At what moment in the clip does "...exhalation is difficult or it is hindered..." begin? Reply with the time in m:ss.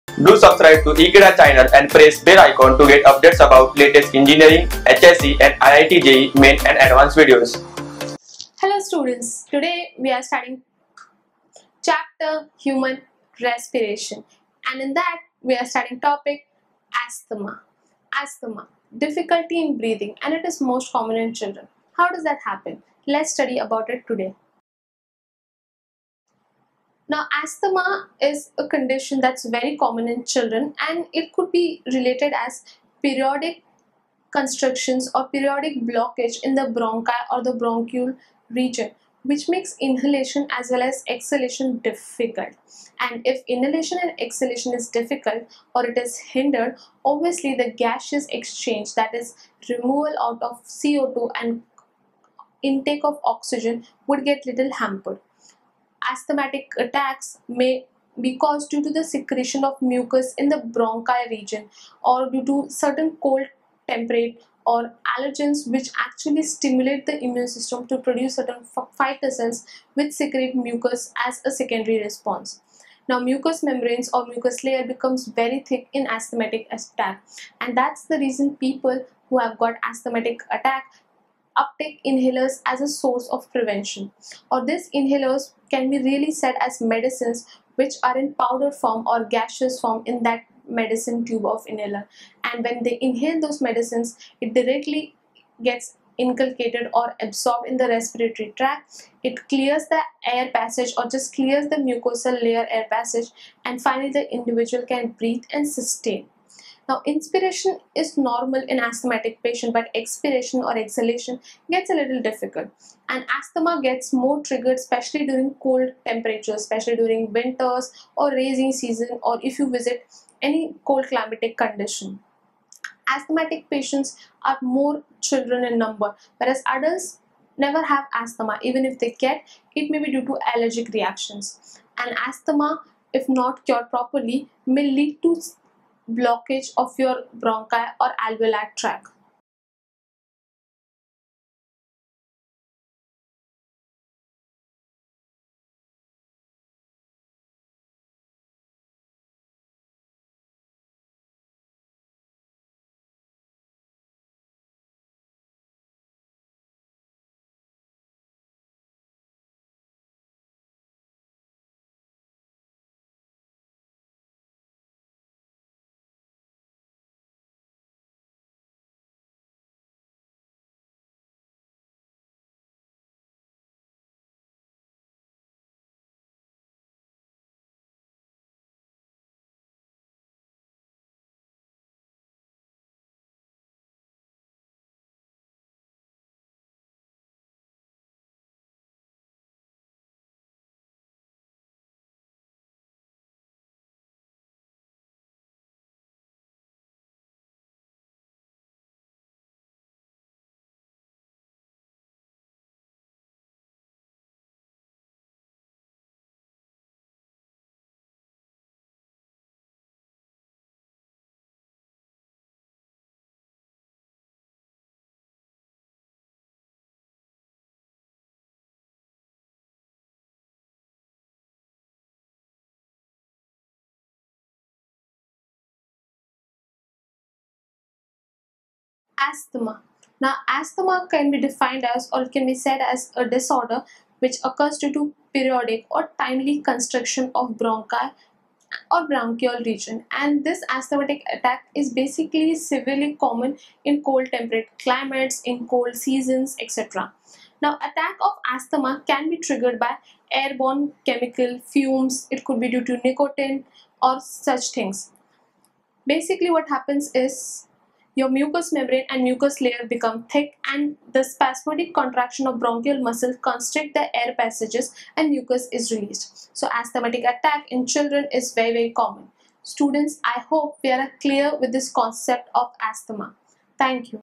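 0:44.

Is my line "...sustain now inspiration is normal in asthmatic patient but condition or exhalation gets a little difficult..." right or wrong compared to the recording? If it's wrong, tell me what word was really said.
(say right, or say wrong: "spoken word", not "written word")
wrong: "expiration", not "condition".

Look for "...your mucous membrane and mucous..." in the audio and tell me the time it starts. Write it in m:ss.
4:18.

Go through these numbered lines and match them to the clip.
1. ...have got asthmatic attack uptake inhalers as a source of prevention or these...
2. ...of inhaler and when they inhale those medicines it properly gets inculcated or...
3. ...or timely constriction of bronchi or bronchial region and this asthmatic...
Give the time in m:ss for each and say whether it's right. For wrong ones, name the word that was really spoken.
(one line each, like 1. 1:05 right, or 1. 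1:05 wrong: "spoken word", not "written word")
1. 1:19 right
2. 1:31 wrong: "directly", not "properly"
3. 3:55 right.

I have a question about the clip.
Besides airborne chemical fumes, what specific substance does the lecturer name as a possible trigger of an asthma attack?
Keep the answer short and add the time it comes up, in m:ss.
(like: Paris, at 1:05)
nicotine, at 4:13.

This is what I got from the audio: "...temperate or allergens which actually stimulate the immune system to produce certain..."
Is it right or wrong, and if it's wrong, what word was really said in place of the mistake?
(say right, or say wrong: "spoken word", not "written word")
right.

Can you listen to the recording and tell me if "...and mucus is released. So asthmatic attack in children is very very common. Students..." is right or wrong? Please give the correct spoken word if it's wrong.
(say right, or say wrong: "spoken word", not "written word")
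right.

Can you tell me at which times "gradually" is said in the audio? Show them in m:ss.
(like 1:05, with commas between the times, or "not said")
not said.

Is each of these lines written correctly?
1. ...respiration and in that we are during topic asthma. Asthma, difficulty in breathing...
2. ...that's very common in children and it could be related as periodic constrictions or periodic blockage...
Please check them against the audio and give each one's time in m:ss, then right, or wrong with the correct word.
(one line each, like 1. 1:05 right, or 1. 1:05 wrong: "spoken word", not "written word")
1. 0:13 wrong: "studying", not "during"
2. 0:29 right.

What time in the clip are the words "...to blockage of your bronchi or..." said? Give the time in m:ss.
2:15.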